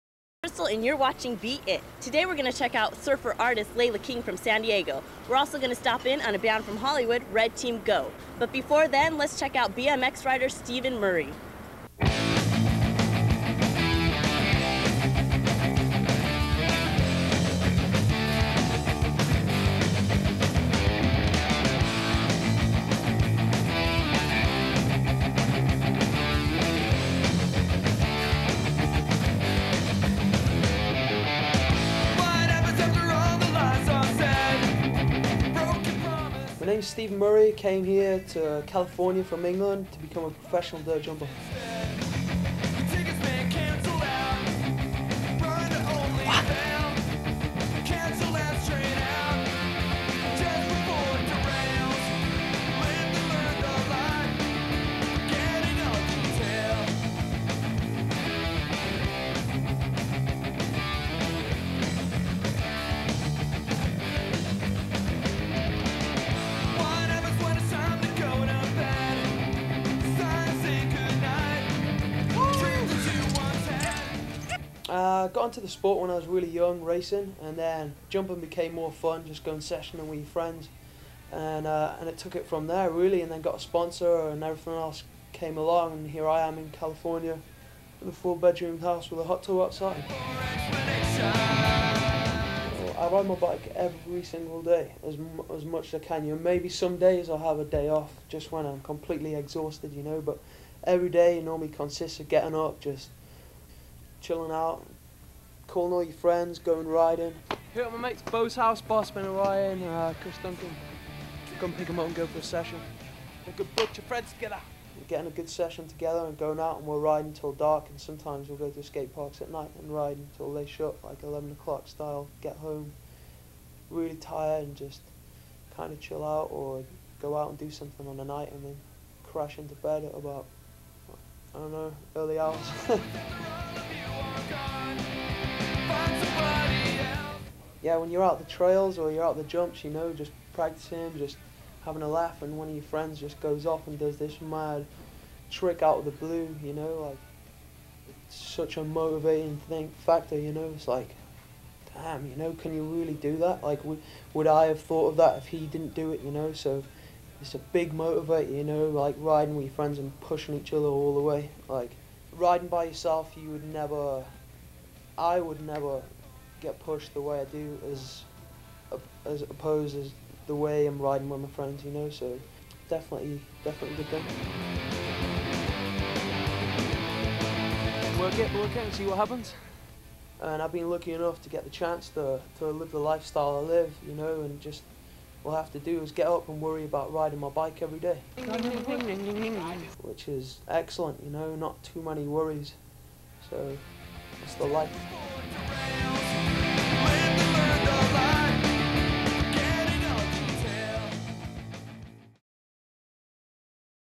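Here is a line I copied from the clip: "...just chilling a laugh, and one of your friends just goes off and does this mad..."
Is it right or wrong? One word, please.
wrong.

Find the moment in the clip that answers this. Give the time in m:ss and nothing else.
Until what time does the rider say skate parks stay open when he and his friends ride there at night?
2:01.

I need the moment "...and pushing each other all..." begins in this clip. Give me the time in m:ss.
2:39.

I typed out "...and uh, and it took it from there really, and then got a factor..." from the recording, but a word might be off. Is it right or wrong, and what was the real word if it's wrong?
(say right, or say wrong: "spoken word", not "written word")
wrong: "sponsor", not "factor".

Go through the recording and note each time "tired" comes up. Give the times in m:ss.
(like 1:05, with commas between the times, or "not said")
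2:04.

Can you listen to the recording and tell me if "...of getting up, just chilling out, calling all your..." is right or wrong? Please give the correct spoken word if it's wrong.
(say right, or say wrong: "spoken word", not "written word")
right.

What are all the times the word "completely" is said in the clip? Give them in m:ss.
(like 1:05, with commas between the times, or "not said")
1:38.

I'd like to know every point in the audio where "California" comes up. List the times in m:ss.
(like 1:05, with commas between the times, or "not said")
0:38, 1:26.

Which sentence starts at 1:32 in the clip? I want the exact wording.
I ride my bike every single day, as as much as I can.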